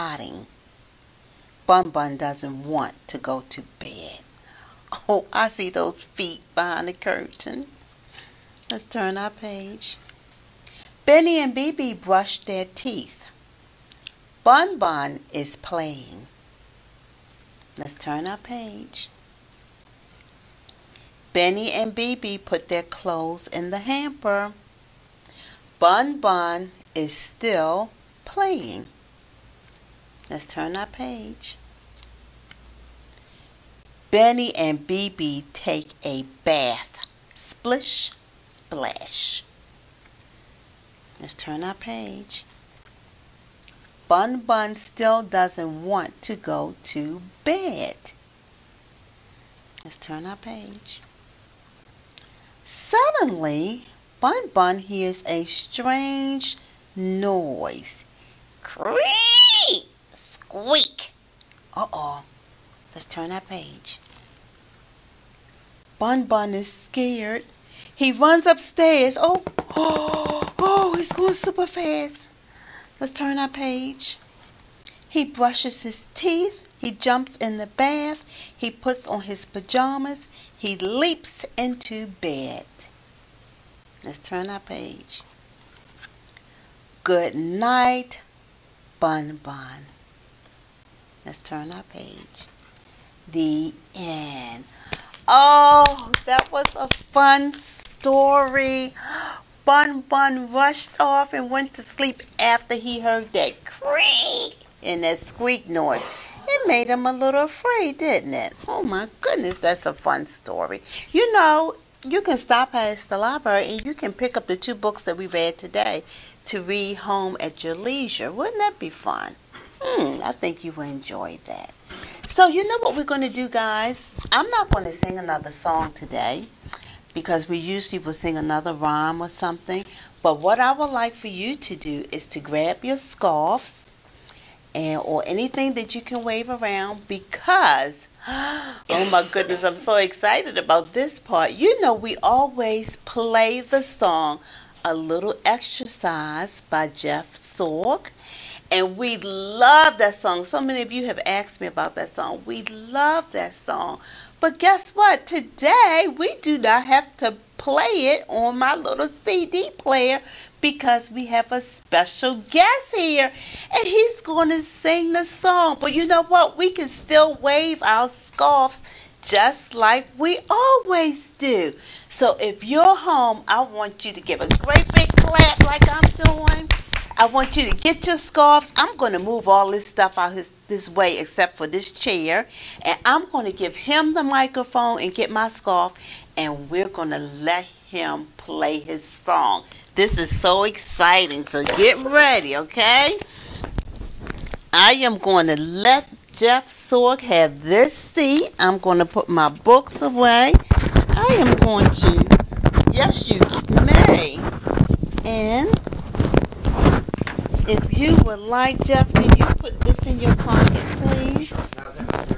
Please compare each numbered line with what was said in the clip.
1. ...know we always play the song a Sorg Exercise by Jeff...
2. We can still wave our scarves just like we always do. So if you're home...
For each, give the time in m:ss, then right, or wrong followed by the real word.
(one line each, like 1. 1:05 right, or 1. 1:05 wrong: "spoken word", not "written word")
1. 2:21 wrong: "Little", not "Sorg"
2. 2:46 right.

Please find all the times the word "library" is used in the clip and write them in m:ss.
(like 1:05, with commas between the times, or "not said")
1:53.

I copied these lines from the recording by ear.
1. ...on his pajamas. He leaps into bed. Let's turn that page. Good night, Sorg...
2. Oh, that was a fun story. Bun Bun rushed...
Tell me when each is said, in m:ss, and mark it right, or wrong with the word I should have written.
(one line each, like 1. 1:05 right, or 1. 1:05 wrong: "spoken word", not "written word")
1. 1:19 wrong: "Bun", not "Sorg"
2. 1:35 right.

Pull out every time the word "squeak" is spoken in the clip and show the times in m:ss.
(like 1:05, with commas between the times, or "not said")
1:00, 1:45.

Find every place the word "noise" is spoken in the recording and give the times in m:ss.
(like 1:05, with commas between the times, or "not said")
0:56, 1:45.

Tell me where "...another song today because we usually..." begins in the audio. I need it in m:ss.
2:05.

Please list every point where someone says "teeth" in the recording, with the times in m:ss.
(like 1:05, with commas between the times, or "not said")
0:12, 1:16.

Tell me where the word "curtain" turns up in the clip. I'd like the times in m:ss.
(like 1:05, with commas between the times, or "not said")
0:06.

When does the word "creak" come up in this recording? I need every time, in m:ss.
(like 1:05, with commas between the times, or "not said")
0:58, 1:43.